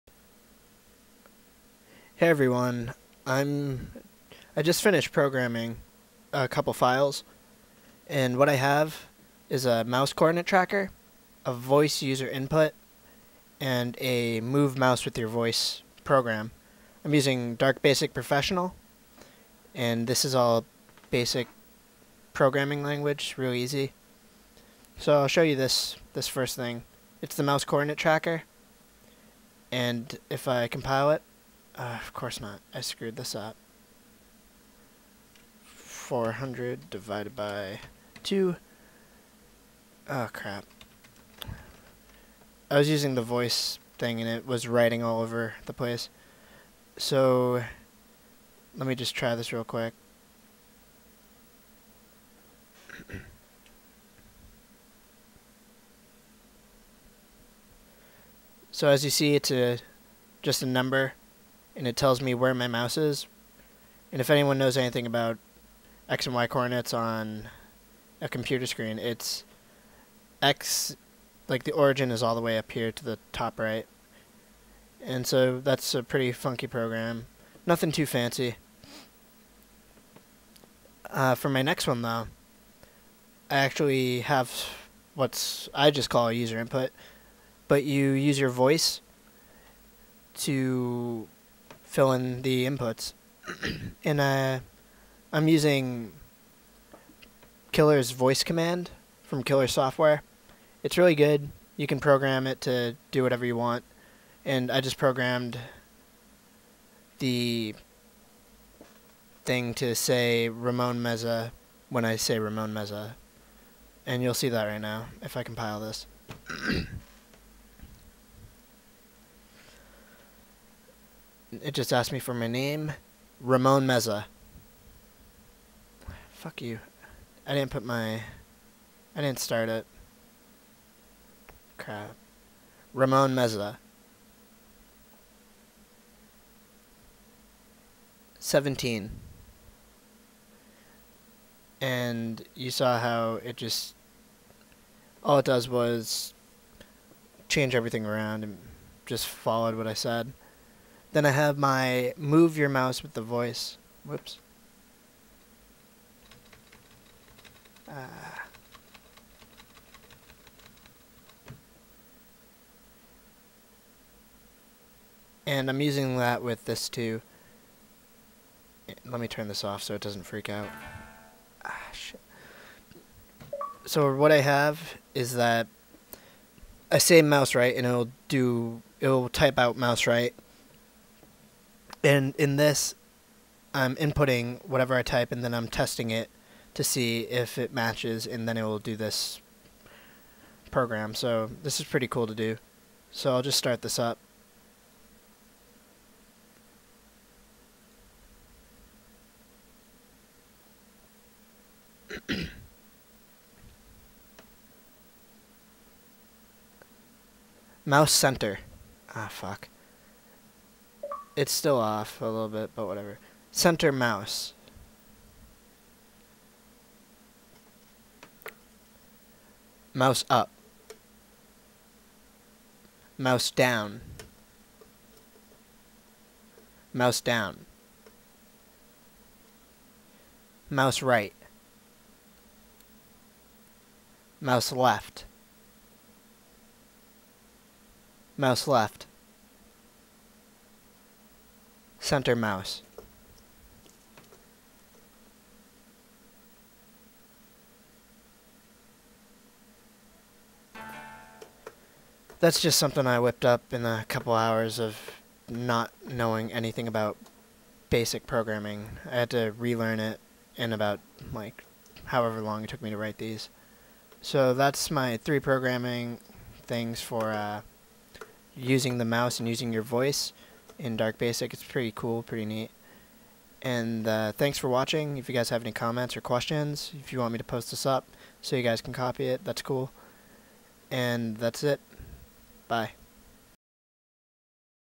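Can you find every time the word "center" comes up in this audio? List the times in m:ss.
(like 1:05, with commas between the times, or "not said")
3:28, 3:33, 4:02.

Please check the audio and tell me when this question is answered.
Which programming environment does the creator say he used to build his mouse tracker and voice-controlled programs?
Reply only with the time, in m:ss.
0:17.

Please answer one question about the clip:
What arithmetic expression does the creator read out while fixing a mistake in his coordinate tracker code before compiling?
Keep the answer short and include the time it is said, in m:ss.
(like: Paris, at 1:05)
400 divided by 2, at 0:35.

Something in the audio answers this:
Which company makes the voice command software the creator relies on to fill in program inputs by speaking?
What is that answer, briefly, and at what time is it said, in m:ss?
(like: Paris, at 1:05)
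Killer Software, at 1:39.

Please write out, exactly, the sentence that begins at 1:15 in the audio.
And so that's a pretty funky program.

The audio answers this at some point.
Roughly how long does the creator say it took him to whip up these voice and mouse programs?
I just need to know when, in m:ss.
4:13.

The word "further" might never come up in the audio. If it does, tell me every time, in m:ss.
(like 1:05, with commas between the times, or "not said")
not said.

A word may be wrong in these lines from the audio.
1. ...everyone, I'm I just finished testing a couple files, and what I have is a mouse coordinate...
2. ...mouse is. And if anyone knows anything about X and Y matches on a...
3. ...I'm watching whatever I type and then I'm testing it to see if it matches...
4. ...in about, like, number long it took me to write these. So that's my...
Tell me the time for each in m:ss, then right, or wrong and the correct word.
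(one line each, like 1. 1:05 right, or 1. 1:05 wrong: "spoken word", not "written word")
1. 0:02 wrong: "programming", not "testing"
2. 1:02 wrong: "coordinates", not "matches"
3. 3:03 wrong: "inputting", not "watching"
4. 4:20 wrong: "however", not "number".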